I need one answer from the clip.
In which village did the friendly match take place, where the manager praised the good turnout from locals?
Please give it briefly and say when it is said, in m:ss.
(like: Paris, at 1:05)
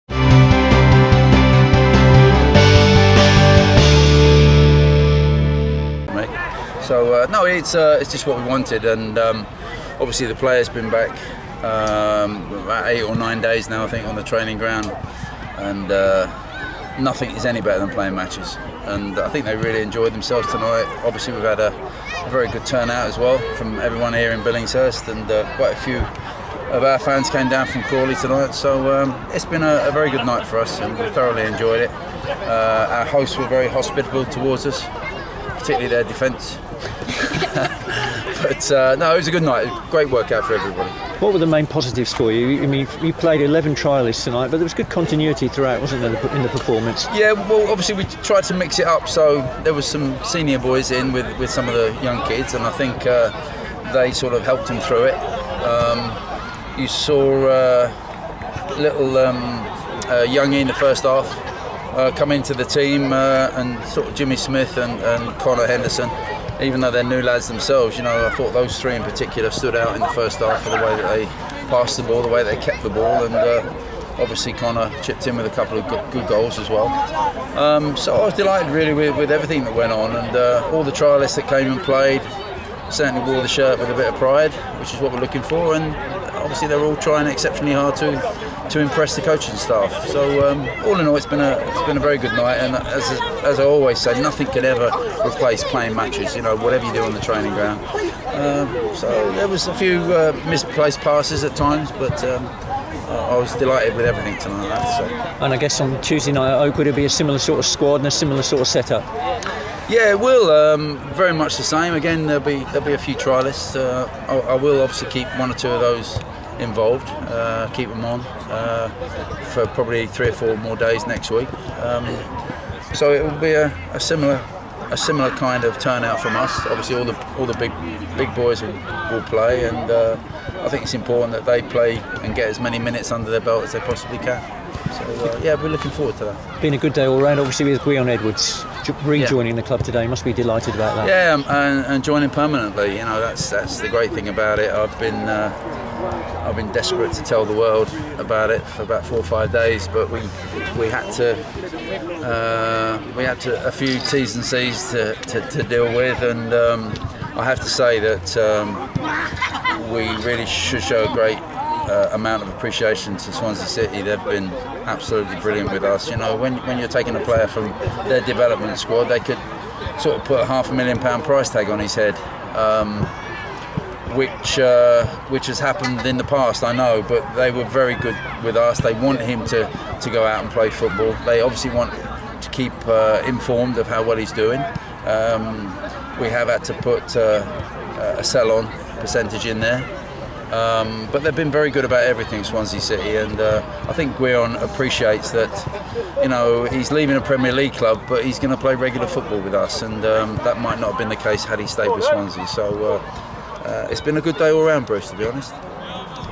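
Billingshurst, at 0:24.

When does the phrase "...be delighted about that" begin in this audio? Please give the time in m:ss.
2:20.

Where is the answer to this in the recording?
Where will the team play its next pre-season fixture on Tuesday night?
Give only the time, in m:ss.
1:46.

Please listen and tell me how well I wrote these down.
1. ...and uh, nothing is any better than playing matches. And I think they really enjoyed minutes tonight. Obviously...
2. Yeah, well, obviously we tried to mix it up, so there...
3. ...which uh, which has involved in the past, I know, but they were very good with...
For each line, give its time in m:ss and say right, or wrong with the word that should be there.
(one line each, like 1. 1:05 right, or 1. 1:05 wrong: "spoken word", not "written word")
1. 0:15 wrong: "themselves", not "minutes"
2. 0:47 right
3. 2:54 wrong: "happened", not "involved".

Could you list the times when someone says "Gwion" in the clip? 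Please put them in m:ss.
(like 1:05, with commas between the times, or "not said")
2:17, 3:14.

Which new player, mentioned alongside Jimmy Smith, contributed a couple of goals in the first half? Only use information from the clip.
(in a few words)
Connor Henderson.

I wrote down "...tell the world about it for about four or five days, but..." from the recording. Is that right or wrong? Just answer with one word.
right.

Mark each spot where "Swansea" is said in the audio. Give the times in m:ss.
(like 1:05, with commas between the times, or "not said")
2:43, 3:12, 3:22.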